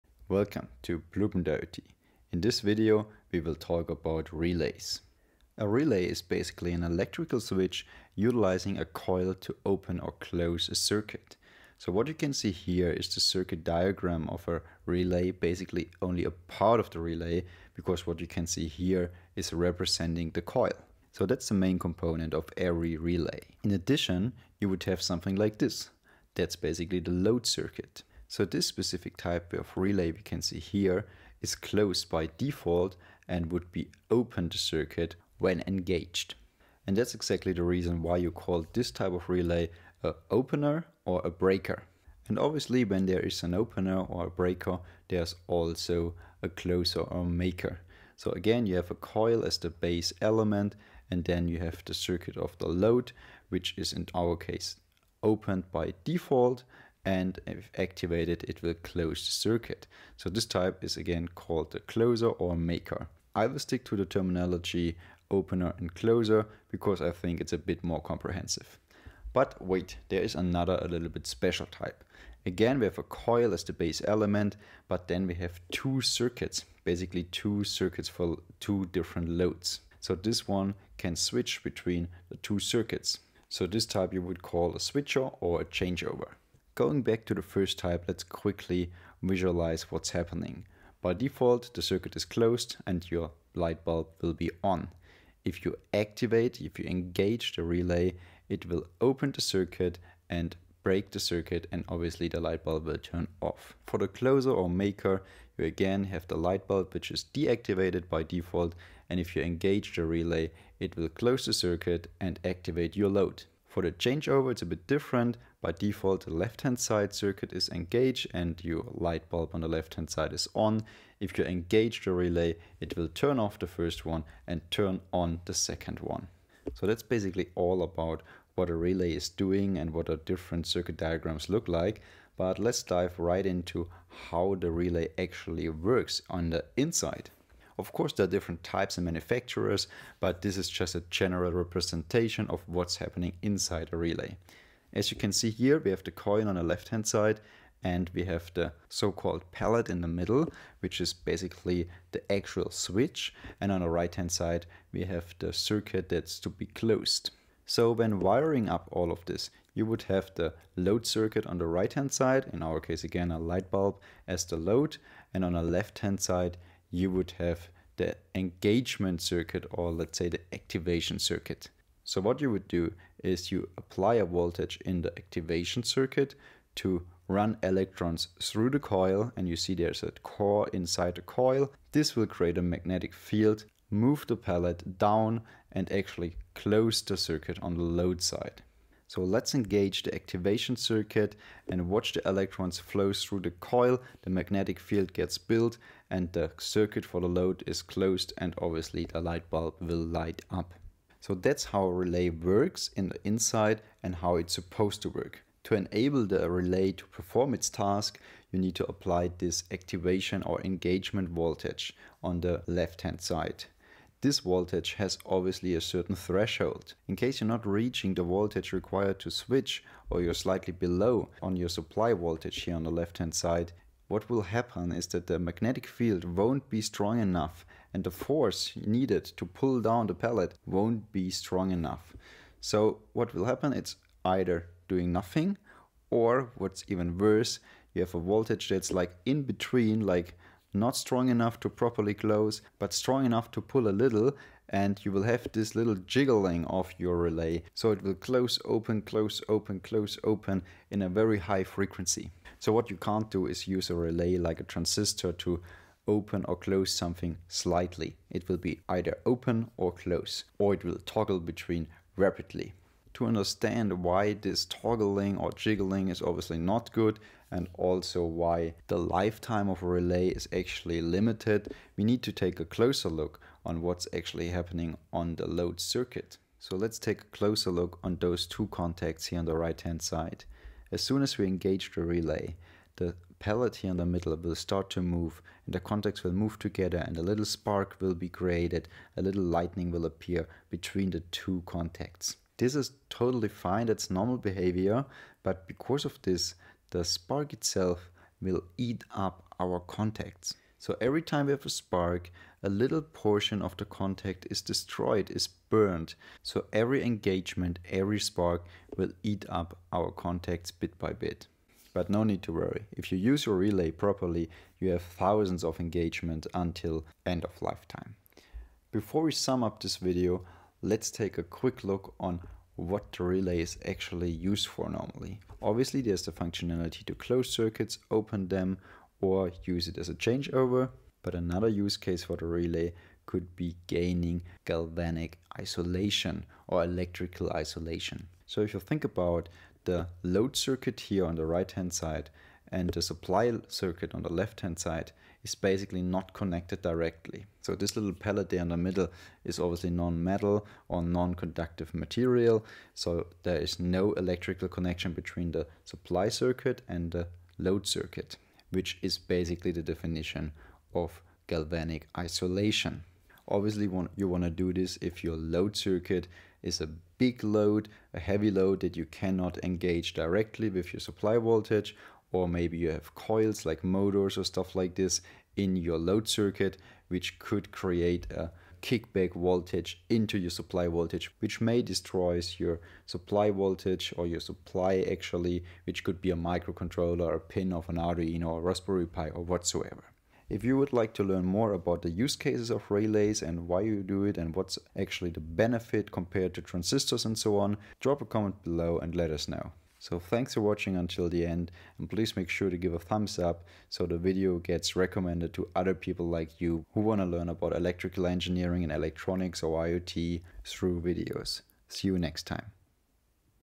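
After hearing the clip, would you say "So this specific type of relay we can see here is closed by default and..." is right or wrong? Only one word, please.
right.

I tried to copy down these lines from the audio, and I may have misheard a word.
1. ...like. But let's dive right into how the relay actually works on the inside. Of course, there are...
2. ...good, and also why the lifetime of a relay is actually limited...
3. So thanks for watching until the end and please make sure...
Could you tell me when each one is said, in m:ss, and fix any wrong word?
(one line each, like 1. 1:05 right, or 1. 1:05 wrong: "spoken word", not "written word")
1. 2:11 right
2. 4:26 right
3. 6:40 right.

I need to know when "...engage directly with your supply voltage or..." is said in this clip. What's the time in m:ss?
6:09.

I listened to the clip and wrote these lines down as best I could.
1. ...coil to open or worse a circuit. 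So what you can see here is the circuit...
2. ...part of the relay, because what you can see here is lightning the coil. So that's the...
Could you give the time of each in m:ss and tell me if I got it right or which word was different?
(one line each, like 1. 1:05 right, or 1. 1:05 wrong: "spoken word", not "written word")
1. 0:08 wrong: "close", not "worse"
2. 0:16 wrong: "representing", not "lightning".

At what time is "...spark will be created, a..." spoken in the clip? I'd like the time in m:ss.
4:47.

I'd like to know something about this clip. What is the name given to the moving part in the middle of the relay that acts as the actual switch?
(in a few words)
pallet.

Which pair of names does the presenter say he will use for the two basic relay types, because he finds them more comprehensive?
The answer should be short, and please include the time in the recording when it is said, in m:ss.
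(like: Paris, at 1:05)
opener and closer, at 1:05.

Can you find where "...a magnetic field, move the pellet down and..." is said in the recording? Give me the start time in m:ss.
3:02.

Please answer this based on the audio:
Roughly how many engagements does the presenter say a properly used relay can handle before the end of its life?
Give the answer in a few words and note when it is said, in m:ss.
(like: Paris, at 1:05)
thousands, at 5:15.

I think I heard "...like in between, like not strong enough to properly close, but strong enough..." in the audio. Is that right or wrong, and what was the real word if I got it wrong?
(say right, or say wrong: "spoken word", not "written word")
right.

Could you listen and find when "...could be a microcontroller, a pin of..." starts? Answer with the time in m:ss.
6:26.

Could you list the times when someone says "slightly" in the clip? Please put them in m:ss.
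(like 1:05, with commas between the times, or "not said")
3:40, 4:17.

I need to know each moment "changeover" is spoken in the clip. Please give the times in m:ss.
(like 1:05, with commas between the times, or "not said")
1:25, 1:53, 5:30.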